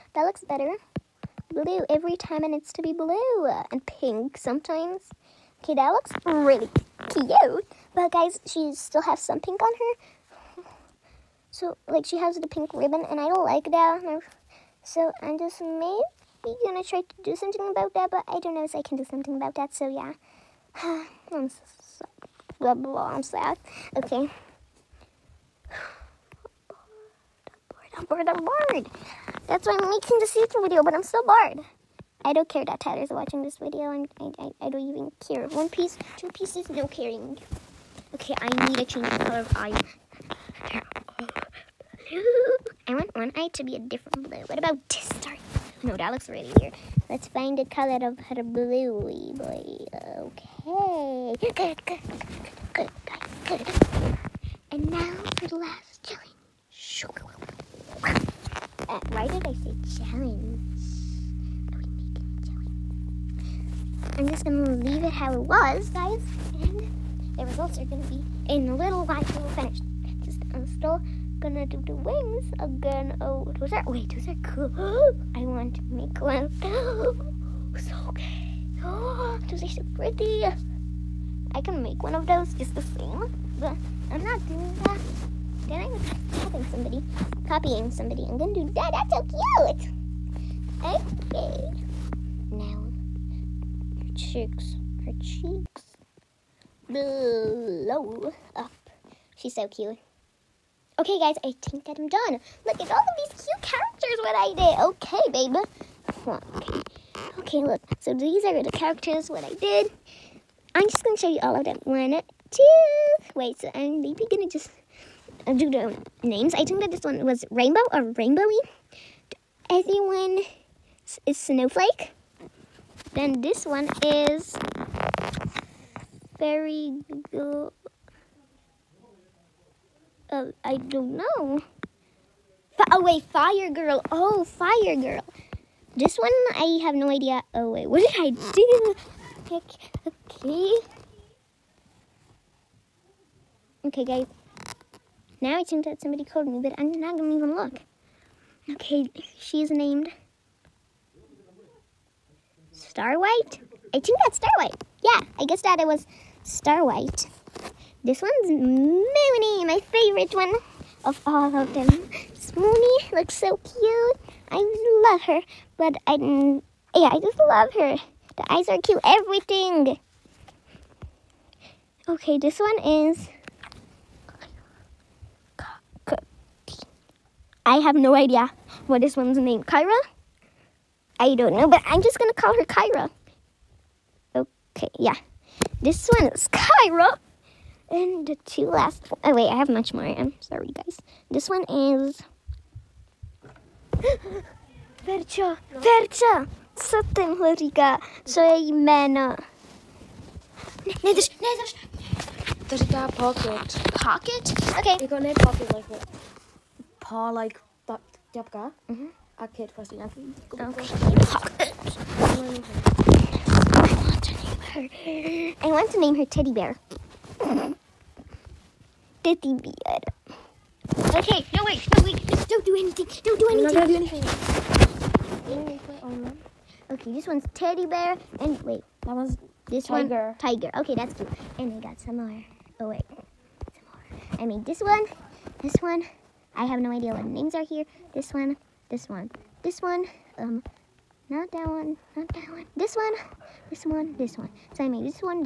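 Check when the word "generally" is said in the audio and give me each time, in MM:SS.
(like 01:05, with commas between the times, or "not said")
not said.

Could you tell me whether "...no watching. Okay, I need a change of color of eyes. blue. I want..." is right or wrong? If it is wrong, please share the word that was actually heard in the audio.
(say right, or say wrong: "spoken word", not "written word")
wrong: "caring", not "watching".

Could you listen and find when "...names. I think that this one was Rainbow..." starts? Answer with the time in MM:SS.
01:56.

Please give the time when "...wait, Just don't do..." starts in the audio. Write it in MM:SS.
03:42.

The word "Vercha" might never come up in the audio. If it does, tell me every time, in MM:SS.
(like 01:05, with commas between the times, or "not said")
03:15.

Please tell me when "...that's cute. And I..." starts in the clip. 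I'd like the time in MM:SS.
03:50.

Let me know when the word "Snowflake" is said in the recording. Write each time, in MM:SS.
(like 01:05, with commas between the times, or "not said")
02:01.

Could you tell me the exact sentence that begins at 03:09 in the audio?
Oh, wait, I have much more.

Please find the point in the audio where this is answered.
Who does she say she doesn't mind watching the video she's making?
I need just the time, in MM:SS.
00:32.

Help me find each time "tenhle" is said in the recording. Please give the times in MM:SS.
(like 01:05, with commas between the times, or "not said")
03:17.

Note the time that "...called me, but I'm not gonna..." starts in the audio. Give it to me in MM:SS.
02:26.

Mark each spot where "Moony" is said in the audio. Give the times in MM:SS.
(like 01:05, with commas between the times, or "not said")
02:38, 02:42.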